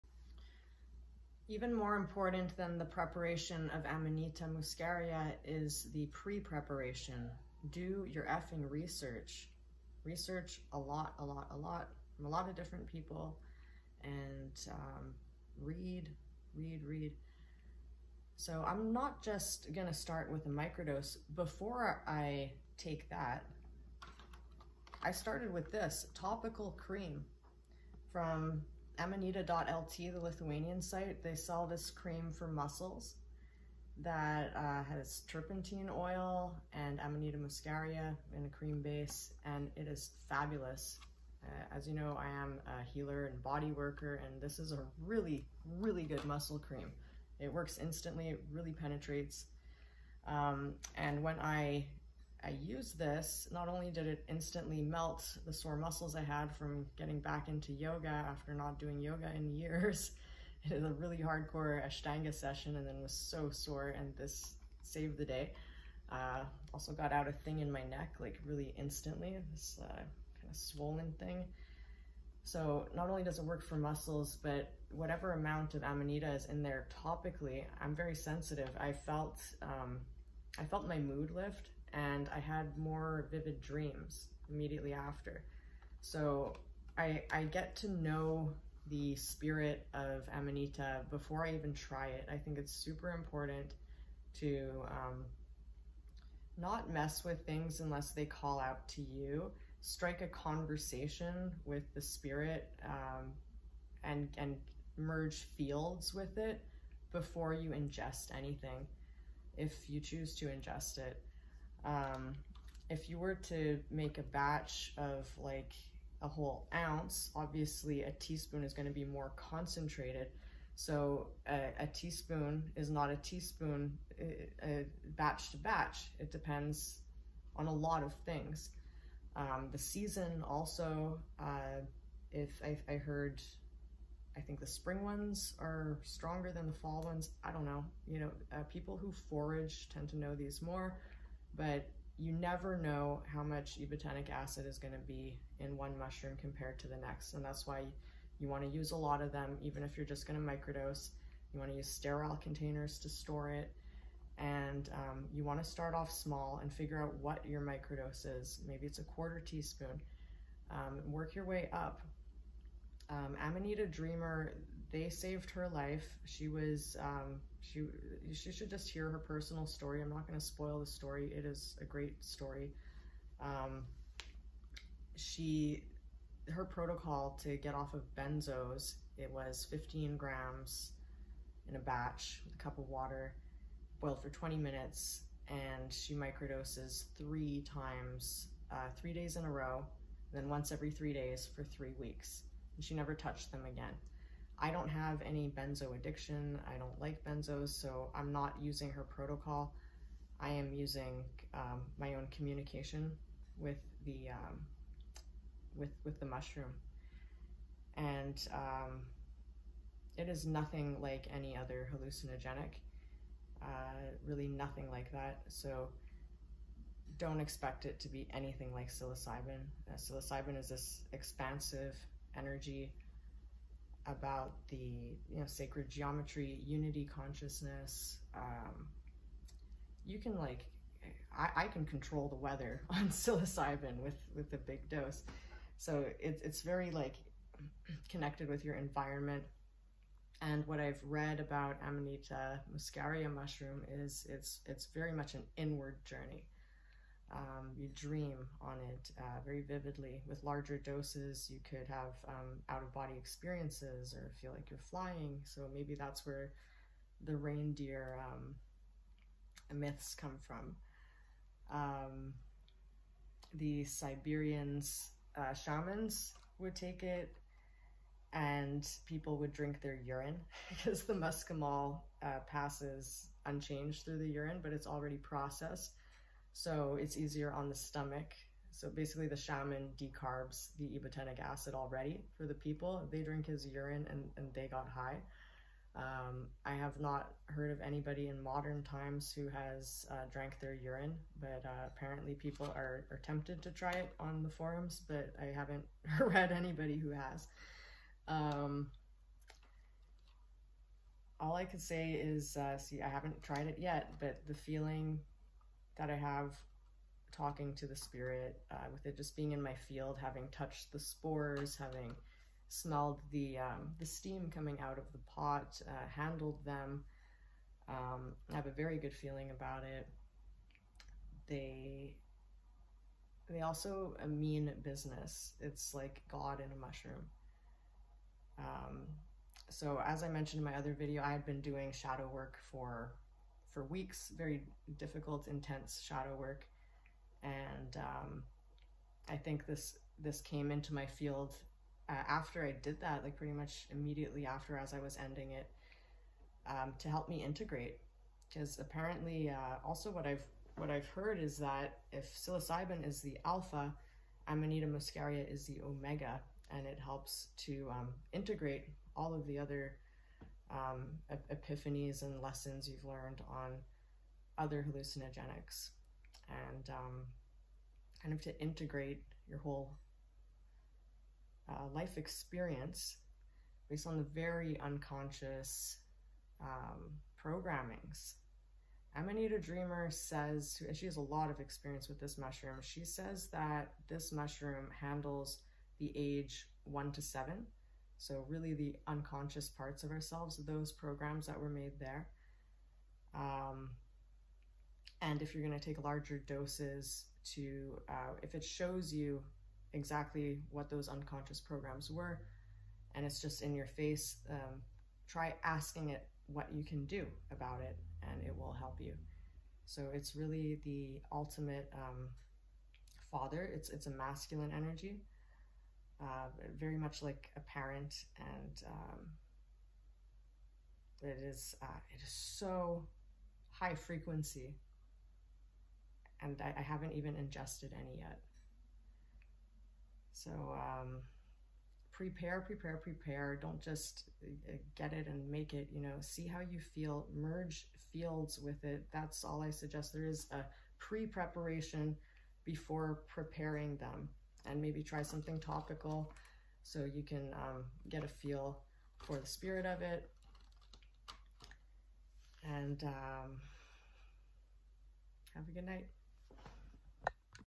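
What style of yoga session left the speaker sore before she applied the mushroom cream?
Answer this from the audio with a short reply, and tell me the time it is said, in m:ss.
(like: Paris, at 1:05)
Ashtanga, at 1:01.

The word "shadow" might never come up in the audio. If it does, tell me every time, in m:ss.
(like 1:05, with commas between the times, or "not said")
5:31, 5:36.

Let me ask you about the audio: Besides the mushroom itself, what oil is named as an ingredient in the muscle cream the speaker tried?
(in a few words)
Turpentine oil.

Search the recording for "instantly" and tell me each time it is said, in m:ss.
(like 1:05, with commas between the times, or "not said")
0:47, 0:54, 1:08.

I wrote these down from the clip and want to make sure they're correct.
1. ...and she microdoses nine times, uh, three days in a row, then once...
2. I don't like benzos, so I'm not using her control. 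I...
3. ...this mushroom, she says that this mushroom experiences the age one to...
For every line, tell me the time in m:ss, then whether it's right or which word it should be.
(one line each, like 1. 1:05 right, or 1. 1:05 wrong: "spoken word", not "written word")
1. 3:05 wrong: "three", not "nine"
2. 3:16 wrong: "protocol", not "control"
3. 6:22 wrong: "handles", not "experiences".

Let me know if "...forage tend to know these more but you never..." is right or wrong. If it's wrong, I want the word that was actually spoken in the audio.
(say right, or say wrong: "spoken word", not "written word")
right.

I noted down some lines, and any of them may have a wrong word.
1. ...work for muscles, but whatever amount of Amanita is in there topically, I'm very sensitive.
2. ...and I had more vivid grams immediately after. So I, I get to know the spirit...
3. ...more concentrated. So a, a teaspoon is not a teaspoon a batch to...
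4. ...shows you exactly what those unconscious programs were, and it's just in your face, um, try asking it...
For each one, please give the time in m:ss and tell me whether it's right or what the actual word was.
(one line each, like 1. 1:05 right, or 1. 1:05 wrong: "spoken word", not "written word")
1. 1:13 right
2. 1:21 wrong: "dreams", not "grams"
3. 1:59 right
4. 6:38 right.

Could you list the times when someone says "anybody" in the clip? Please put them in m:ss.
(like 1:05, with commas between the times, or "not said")
4:47, 4:56.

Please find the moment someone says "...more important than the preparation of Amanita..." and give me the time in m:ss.
0:01.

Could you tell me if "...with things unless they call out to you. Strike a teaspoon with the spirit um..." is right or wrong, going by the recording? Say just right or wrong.
wrong.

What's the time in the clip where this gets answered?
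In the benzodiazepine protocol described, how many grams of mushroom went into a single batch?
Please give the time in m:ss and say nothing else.
2:59.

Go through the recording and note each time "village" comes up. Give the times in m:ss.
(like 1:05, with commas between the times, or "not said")
not said.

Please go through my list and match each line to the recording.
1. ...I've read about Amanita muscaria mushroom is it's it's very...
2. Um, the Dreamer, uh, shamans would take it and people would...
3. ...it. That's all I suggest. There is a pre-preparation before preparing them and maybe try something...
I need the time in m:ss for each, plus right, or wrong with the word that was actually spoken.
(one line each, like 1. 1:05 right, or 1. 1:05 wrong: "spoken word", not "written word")
1. 4:00 right
2. 4:21 wrong: "Siberians", not "Dreamer"
3. 7:18 right.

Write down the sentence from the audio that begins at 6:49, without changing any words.
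So it's really the ultimate um, father.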